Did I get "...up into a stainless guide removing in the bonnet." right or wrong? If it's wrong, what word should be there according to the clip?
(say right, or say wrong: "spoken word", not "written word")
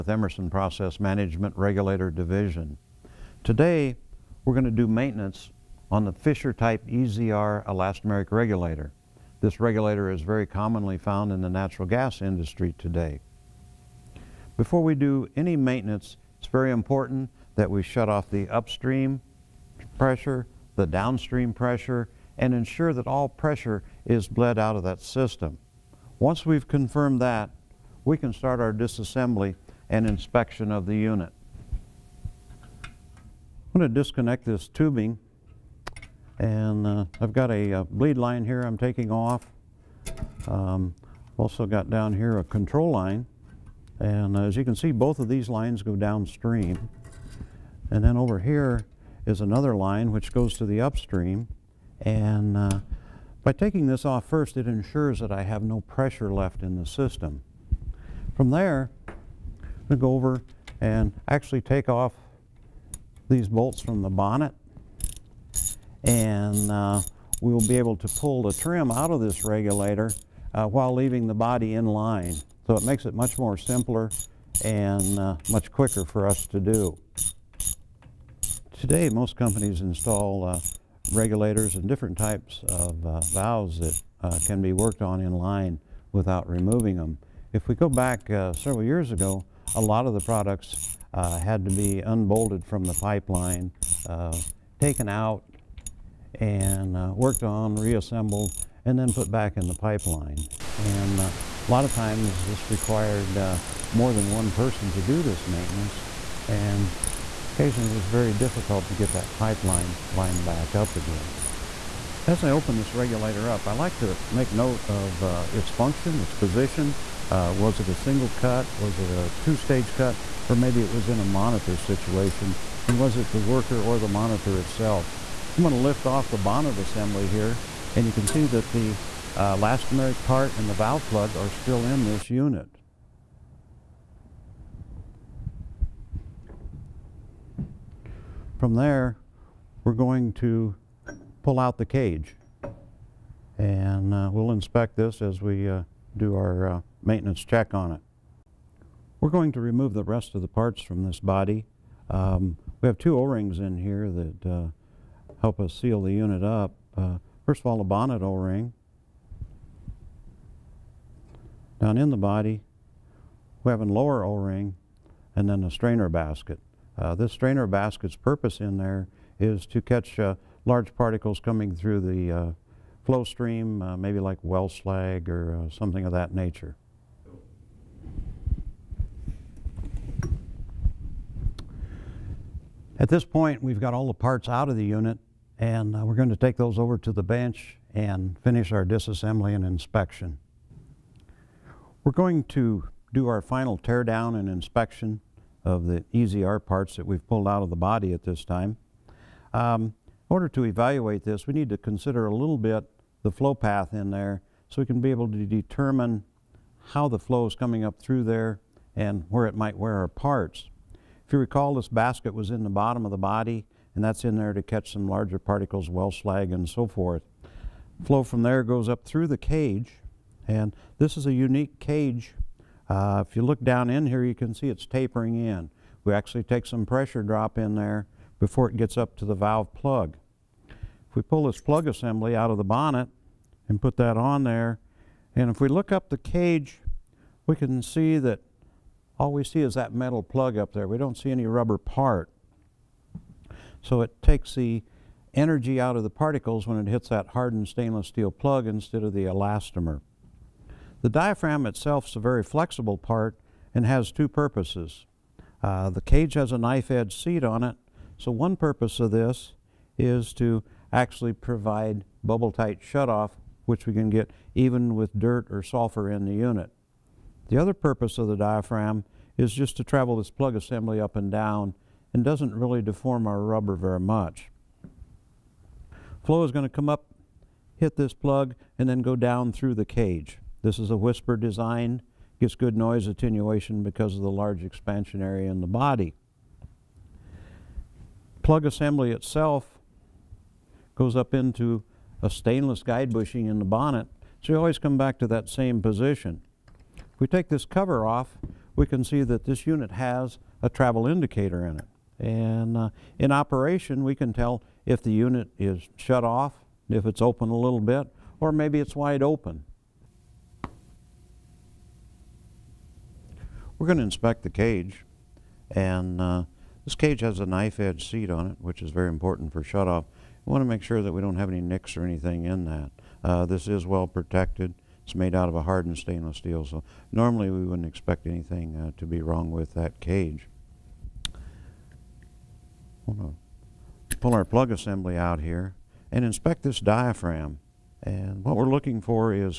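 wrong: "bushing", not "removing".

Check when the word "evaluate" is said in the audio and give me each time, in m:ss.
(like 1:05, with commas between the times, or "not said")
3:20.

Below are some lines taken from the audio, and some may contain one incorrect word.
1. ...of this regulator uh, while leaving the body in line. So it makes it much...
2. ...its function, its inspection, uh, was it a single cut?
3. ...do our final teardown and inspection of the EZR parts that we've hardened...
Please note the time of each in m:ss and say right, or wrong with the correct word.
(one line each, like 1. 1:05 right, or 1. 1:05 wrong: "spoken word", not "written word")
1. 1:09 right
2. 1:55 wrong: "position", not "inspection"
3. 3:13 wrong: "pulled", not "hardened".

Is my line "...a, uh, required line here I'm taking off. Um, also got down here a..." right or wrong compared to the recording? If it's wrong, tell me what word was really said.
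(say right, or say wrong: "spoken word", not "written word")
wrong: "bleed", not "required".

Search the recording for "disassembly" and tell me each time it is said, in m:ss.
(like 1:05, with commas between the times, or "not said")
0:28, 3:08.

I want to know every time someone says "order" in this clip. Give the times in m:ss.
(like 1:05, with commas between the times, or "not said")
3:20.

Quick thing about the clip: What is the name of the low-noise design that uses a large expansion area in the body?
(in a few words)
whisper design.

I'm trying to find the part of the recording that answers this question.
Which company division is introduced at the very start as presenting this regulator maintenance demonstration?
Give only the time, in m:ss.
0:00.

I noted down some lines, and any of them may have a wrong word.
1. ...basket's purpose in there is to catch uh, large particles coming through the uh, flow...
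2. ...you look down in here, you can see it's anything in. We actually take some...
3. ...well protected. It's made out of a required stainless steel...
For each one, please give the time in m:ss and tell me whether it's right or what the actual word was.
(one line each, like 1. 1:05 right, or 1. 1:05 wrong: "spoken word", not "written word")
1. 2:47 right
2. 3:43 wrong: "tapering", not "anything"
3. 5:23 wrong: "hardened", not "required".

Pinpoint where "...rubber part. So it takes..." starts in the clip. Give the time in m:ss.
4:01.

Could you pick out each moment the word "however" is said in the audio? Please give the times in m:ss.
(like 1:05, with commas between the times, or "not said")
not said.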